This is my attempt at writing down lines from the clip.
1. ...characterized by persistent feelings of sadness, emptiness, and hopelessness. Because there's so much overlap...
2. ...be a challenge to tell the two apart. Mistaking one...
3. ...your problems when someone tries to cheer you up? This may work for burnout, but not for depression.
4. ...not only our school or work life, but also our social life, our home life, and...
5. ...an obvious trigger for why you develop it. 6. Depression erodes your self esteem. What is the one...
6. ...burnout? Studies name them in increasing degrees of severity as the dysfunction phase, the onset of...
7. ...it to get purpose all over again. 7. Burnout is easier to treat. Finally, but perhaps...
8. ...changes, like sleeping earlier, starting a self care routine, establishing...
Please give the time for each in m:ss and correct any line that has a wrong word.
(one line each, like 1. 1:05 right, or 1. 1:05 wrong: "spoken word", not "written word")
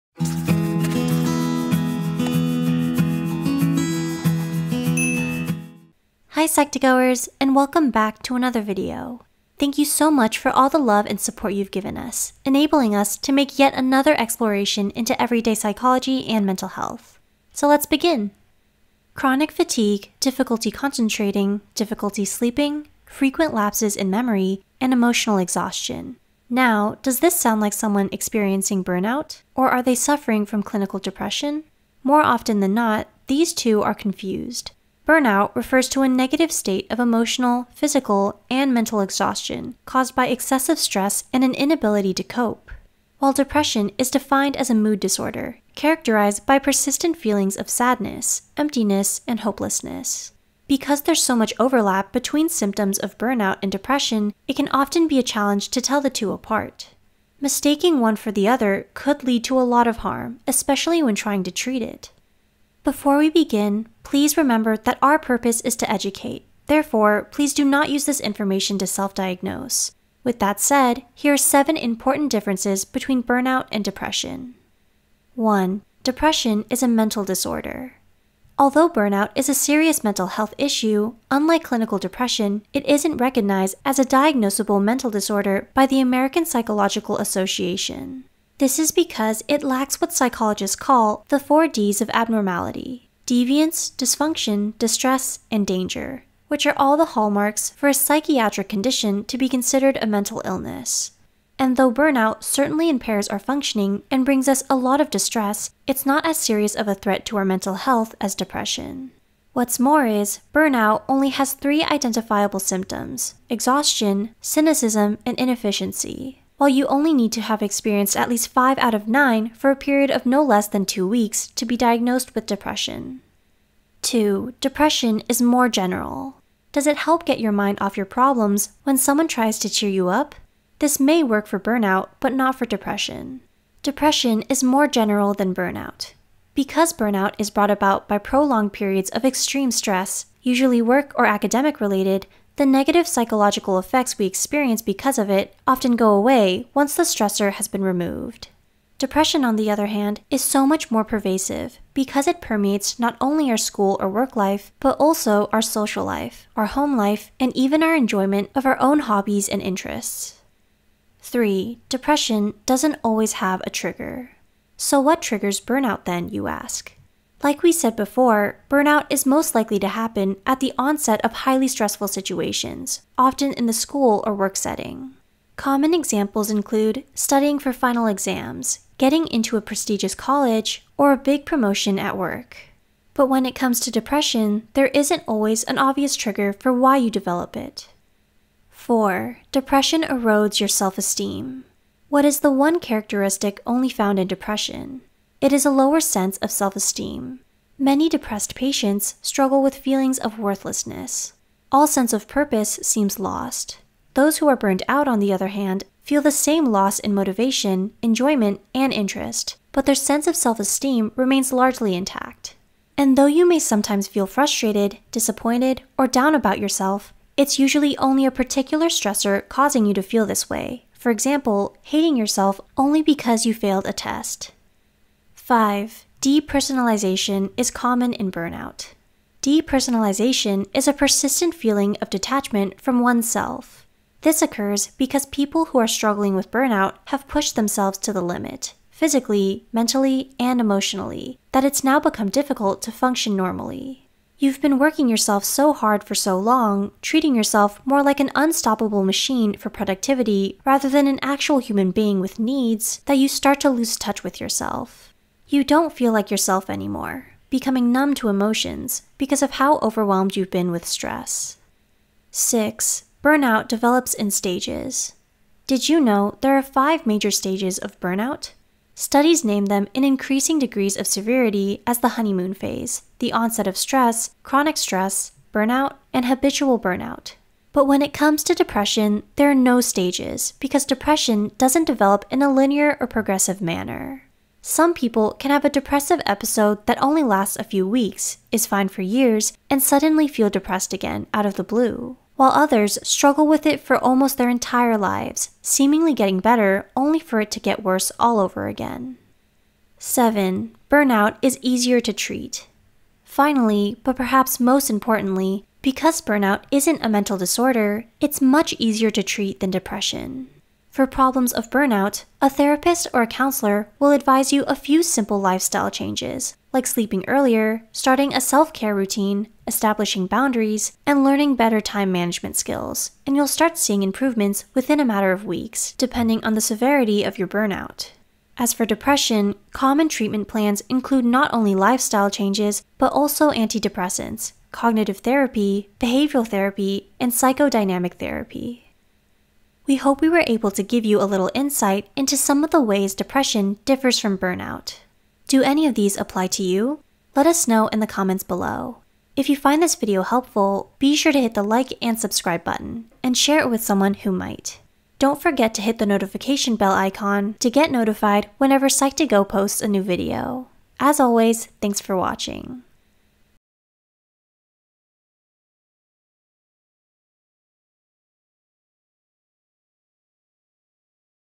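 1. 0:45 right
2. 0:55 right
3. 2:07 right
4. 2:32 right
5. 3:05 wrong: "4", not "6"
6. 4:27 wrong: "honeymoon", not "dysfunction"
7. 4:57 wrong: "worse", not "purpose"
8. 5:15 right.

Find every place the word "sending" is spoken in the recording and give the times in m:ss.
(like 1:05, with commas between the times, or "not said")
not said.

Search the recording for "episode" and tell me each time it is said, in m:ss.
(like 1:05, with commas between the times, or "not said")
4:46.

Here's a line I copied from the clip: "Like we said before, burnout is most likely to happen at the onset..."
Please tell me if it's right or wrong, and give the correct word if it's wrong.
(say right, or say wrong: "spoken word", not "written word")
right.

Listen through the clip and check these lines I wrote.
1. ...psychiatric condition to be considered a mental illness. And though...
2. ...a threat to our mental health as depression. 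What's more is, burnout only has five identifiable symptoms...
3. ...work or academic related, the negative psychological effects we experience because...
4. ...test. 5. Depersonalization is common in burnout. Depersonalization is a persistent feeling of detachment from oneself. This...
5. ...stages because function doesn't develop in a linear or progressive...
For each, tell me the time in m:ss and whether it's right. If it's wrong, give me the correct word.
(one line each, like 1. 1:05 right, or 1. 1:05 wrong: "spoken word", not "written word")
1. 1:37 right
2. 1:46 wrong: "three", not "five"
3. 2:20 right
4. 3:43 right
5. 4:39 wrong: "depression", not "function".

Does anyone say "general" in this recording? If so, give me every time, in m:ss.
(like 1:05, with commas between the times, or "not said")
2:05, 2:14.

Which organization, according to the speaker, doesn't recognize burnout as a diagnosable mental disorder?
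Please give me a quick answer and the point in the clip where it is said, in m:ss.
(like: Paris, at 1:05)
American Psychological Association, at 1:26.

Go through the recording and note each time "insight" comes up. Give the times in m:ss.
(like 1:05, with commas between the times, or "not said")
5:41.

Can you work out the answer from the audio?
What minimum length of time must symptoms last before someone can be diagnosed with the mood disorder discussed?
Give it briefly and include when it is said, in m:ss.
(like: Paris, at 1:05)
2 weeks, at 2:00.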